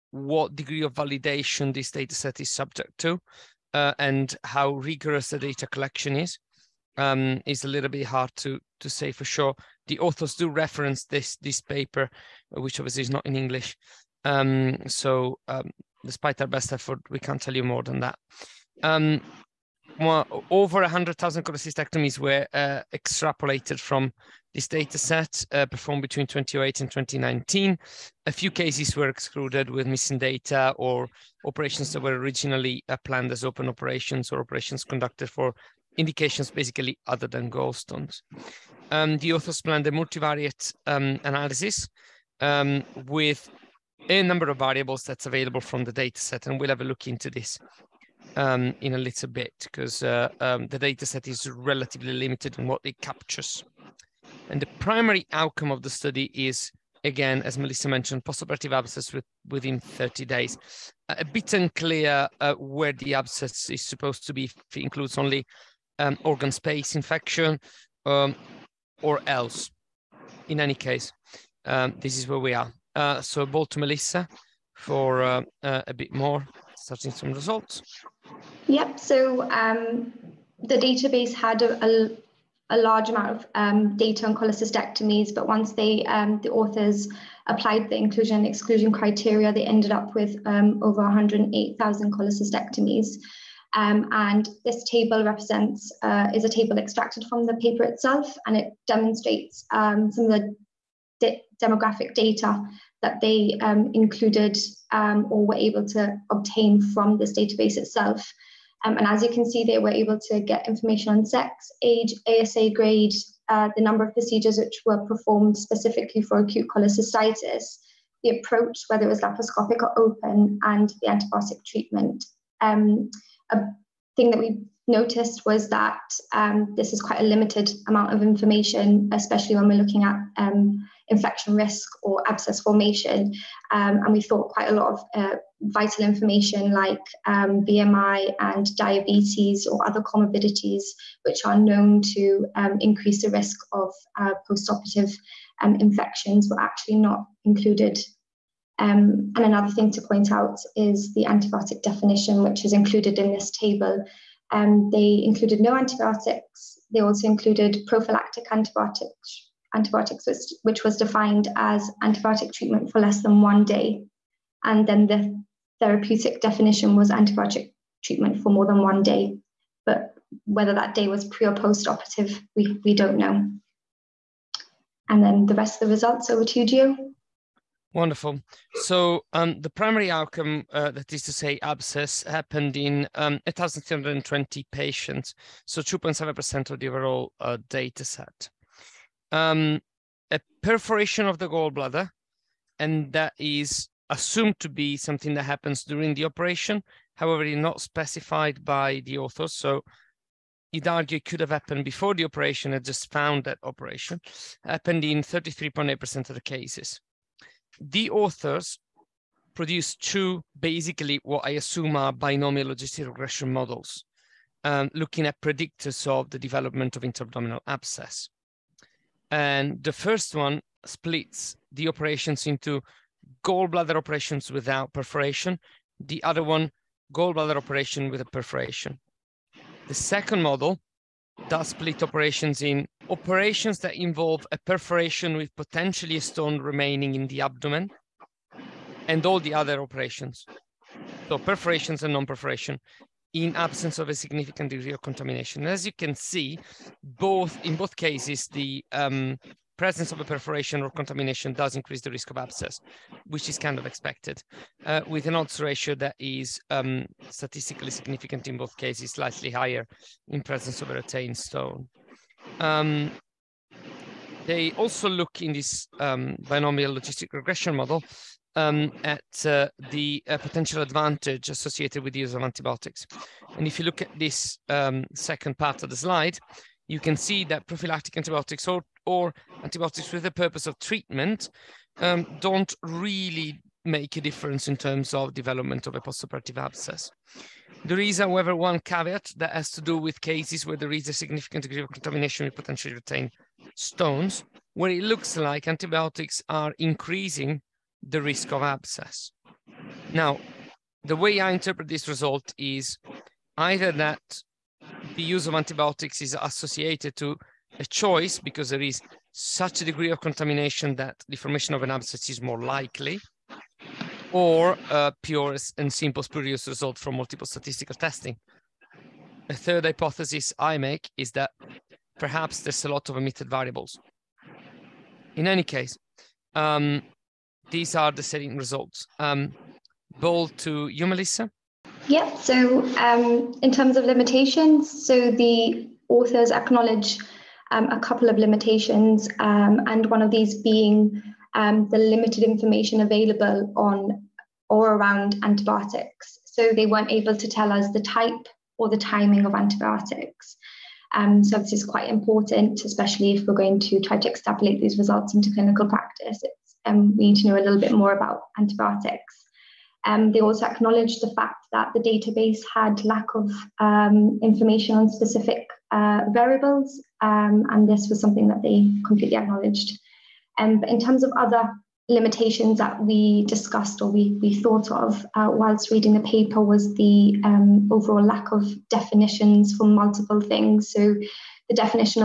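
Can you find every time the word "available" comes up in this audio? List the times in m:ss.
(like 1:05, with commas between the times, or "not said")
0:45, 5:43.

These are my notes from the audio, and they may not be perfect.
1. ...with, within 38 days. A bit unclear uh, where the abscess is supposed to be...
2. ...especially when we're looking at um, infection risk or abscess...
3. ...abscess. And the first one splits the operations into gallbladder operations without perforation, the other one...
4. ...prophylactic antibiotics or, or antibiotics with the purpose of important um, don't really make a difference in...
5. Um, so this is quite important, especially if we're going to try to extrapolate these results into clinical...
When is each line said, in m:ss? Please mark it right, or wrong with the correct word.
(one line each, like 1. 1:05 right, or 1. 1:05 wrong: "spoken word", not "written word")
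1. 0:59 wrong: "30", not "38"
2. 2:09 right
3. 3:37 right
4. 4:37 wrong: "treatment", not "important"
5. 5:51 right.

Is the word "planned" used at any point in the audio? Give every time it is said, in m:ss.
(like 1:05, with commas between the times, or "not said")
0:33, 0:39.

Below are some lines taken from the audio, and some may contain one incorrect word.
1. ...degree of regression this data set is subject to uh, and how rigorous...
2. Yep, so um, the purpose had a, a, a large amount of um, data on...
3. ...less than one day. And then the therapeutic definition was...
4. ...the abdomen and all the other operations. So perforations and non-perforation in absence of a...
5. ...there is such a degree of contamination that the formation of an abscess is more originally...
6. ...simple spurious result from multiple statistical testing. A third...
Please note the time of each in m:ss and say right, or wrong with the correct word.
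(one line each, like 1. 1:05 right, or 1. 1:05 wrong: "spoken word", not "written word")
1. 0:00 wrong: "validation", not "regression"
2. 1:18 wrong: "database", not "purpose"
3. 2:43 right
4. 3:57 right
5. 5:08 wrong: "likely", not "originally"
6. 5:15 right.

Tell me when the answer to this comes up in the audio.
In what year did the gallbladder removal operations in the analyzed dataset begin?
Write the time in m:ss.
0:26.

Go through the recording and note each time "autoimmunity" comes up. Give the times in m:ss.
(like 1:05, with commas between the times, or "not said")
not said.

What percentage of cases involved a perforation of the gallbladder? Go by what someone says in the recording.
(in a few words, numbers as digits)
33.8%.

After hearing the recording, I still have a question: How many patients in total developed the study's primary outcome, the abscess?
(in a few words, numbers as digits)
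1,320.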